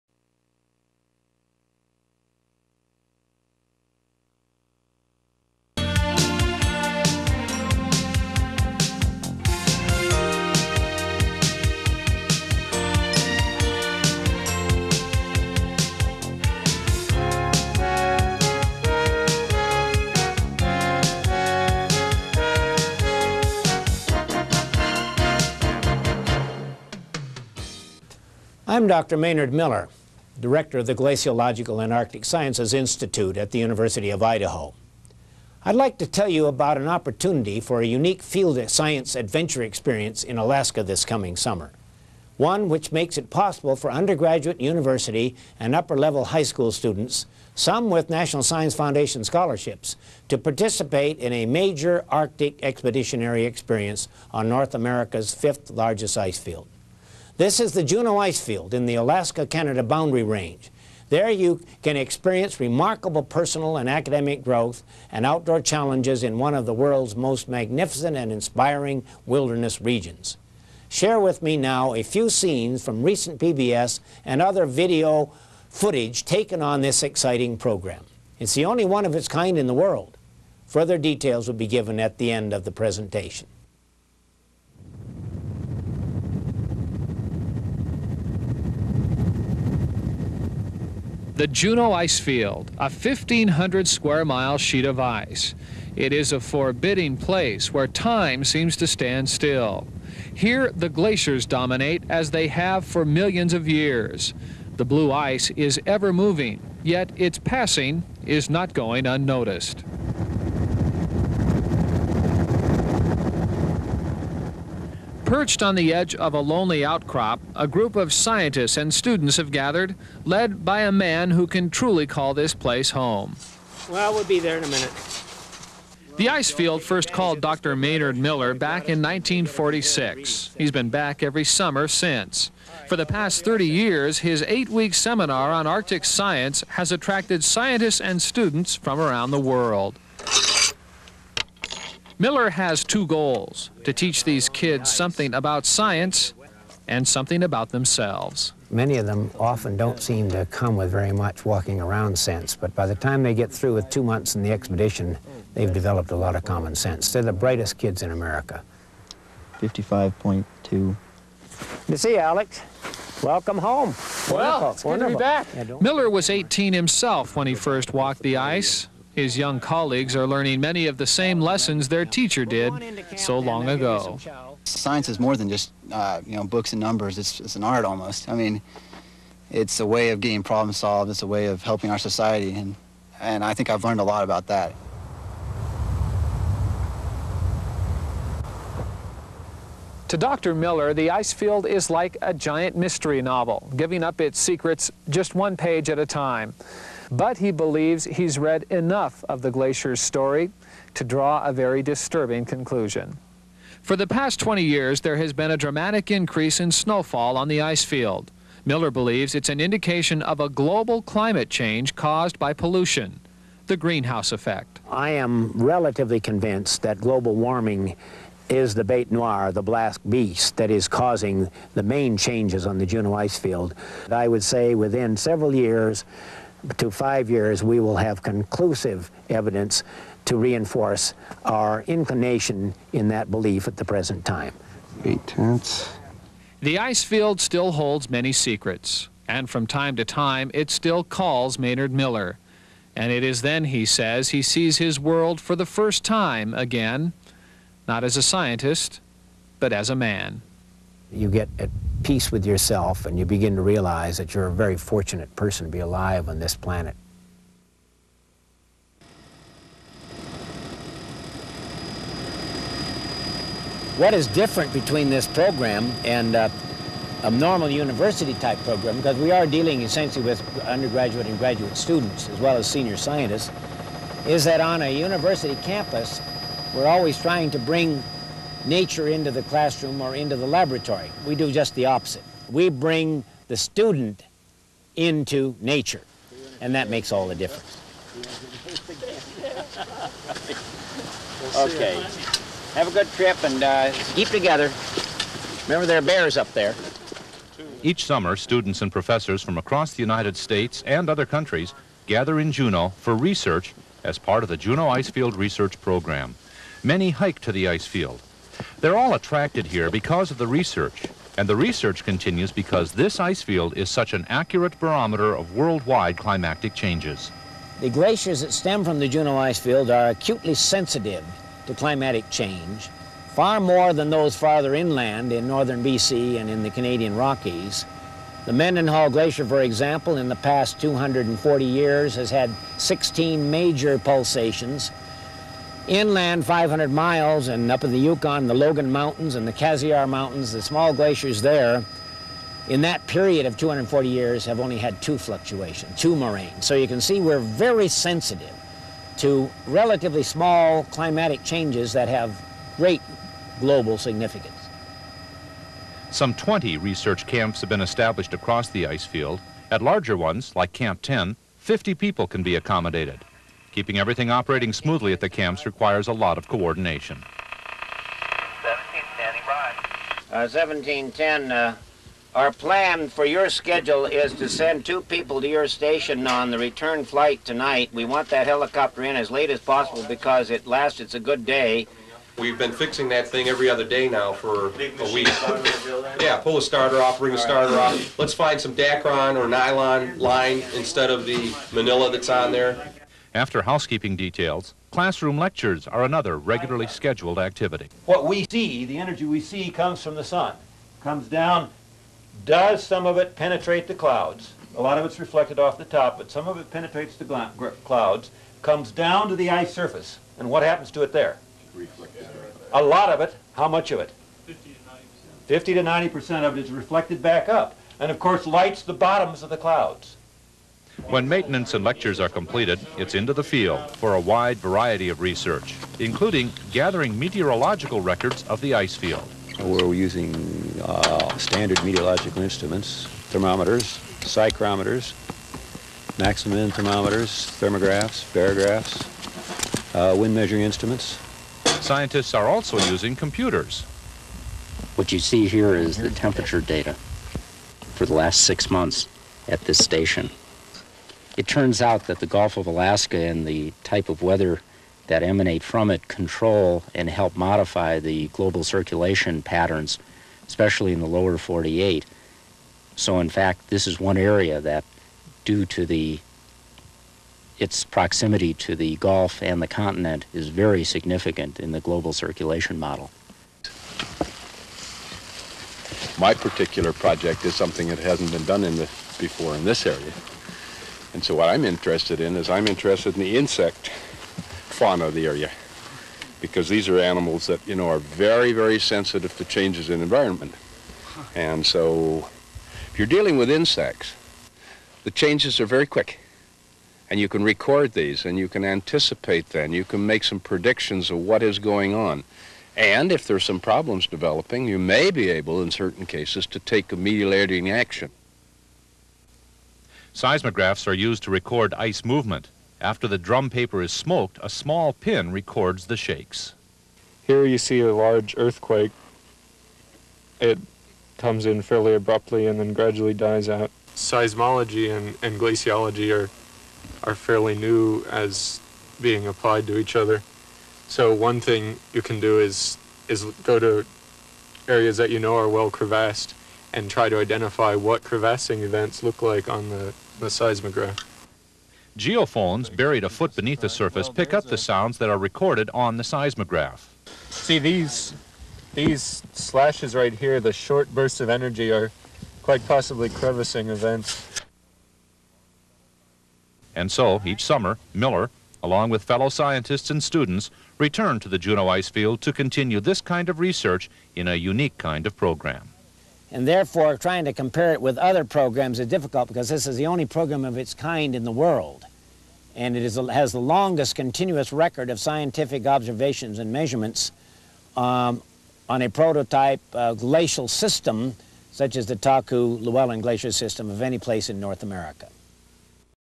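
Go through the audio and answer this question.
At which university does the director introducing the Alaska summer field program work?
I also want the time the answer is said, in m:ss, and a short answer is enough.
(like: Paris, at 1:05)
University of Idaho, at 0:33.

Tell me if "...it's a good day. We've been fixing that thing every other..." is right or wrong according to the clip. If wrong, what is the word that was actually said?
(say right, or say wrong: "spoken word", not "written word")
right.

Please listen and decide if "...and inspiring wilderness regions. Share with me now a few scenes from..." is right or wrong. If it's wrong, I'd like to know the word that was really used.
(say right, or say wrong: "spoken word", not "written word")
right.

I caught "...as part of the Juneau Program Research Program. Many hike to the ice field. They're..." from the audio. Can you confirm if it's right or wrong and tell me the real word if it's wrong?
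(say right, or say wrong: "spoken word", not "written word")
wrong: "Icefield", not "Program".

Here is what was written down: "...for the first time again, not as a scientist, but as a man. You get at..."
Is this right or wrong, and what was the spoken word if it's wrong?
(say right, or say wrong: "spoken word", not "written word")
right.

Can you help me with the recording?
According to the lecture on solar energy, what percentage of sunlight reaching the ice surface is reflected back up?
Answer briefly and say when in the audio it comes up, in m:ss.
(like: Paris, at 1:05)
50 to 90%, at 6:55.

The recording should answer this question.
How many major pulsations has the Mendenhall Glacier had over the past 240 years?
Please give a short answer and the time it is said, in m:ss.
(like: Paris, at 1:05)
16, at 5:32.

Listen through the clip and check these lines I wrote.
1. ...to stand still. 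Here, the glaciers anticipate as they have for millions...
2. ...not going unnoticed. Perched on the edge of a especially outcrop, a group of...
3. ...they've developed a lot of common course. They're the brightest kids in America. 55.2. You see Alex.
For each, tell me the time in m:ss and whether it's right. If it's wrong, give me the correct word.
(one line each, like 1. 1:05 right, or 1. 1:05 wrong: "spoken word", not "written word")
1. 1:38 wrong: "dominate", not "anticipate"
2. 1:48 wrong: "lonely", not "especially"
3. 2:35 wrong: "sense", not "course".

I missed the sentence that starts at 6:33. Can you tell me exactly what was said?
After housekeeping details, classroom lectures are another regularly scheduled activity.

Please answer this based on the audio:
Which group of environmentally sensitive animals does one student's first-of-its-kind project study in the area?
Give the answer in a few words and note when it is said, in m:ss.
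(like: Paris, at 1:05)
insects, at 8:03.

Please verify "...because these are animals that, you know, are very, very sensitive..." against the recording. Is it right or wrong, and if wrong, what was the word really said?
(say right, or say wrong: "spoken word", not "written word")
right.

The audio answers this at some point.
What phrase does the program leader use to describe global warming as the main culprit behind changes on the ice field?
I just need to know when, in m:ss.
3:38.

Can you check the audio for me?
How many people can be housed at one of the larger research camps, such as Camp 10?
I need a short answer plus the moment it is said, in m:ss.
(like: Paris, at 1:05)
50, at 6:01.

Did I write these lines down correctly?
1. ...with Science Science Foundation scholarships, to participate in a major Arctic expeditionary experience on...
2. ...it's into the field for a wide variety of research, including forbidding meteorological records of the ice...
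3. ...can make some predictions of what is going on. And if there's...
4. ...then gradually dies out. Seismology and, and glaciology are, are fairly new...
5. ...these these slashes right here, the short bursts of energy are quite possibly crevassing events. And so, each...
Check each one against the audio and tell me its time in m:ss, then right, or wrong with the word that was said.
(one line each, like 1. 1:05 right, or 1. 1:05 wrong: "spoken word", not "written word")
1. 0:47 wrong: "National", not "Science"
2. 7:02 wrong: "gathering", not "forbidding"
3. 8:19 right
4. 8:42 right
5. 9:07 right.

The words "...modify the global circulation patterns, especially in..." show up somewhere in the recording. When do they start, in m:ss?
7:37.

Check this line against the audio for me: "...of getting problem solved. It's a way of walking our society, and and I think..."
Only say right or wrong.
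wrong.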